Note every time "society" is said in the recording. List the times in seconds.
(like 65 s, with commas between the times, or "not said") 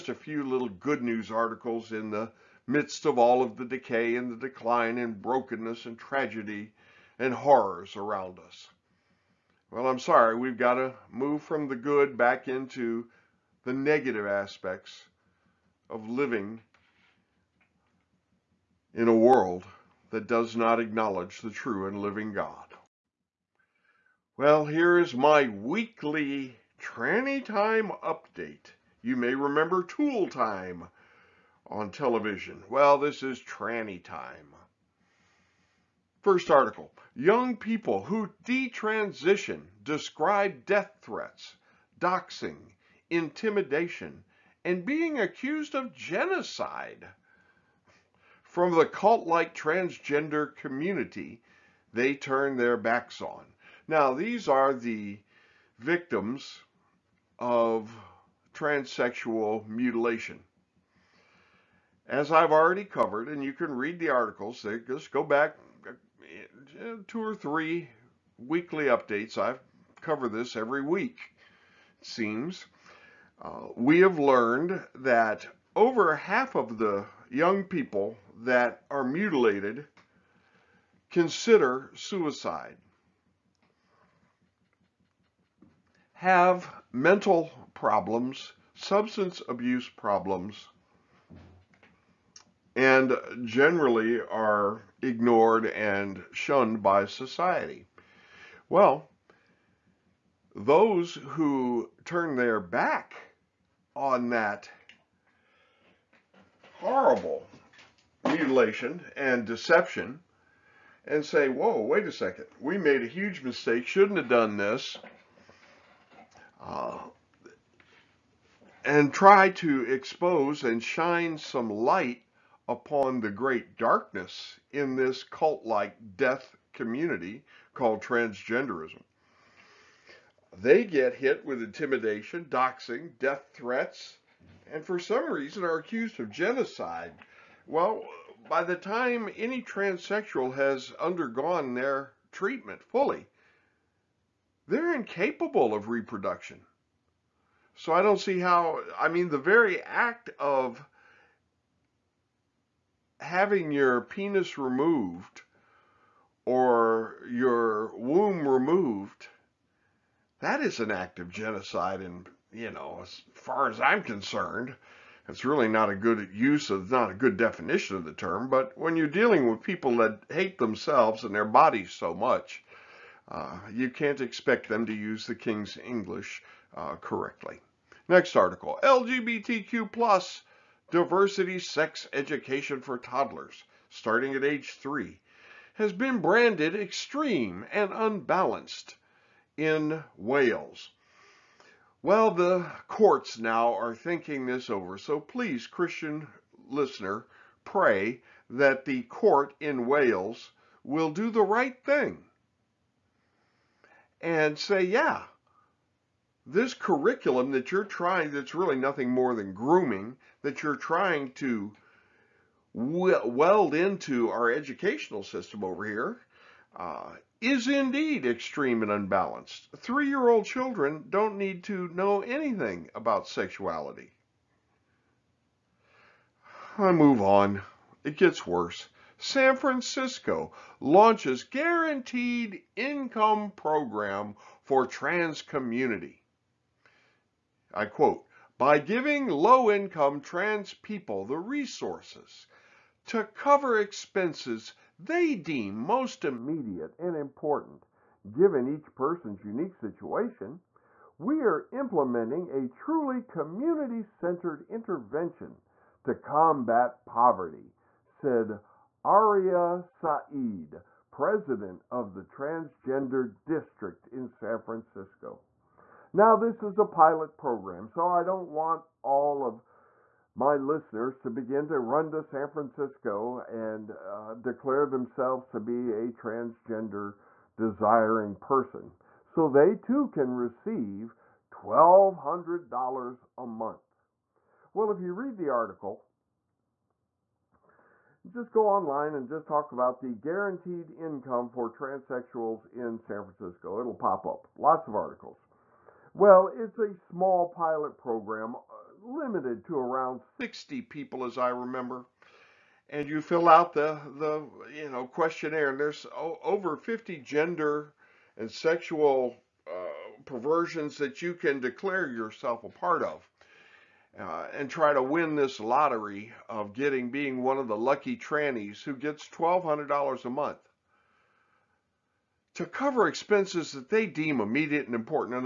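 97 s.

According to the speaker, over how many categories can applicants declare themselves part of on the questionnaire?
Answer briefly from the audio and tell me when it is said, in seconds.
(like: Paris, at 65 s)
50, at 306 s.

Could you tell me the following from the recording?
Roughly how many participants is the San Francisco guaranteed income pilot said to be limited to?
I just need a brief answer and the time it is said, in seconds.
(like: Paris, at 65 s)
60, at 300 s.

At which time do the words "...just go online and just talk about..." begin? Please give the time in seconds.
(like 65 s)
288 s.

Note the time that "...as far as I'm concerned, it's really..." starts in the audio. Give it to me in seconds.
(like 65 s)
163 s.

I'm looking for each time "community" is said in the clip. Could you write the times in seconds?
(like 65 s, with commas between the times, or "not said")
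50 s, 126 s, 235 s, 253 s.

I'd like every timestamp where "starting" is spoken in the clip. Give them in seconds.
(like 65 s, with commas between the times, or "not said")
183 s.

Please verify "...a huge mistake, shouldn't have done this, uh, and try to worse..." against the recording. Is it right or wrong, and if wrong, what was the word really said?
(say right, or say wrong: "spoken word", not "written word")
wrong: "expose", not "worse".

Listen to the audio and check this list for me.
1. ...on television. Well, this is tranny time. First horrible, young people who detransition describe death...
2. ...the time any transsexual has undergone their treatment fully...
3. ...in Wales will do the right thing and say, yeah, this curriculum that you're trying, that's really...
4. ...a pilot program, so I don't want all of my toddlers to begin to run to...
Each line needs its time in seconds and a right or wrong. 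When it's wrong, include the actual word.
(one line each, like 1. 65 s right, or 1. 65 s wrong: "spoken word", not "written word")
1. 31 s wrong: "article", not "horrible"
2. 138 s right
3. 199 s right
4. 266 s wrong: "listeners", not "toddlers".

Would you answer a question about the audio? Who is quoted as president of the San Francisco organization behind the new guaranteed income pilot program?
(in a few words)
Aria Sa'id.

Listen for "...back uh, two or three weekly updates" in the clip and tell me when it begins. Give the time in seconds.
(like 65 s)
65 s.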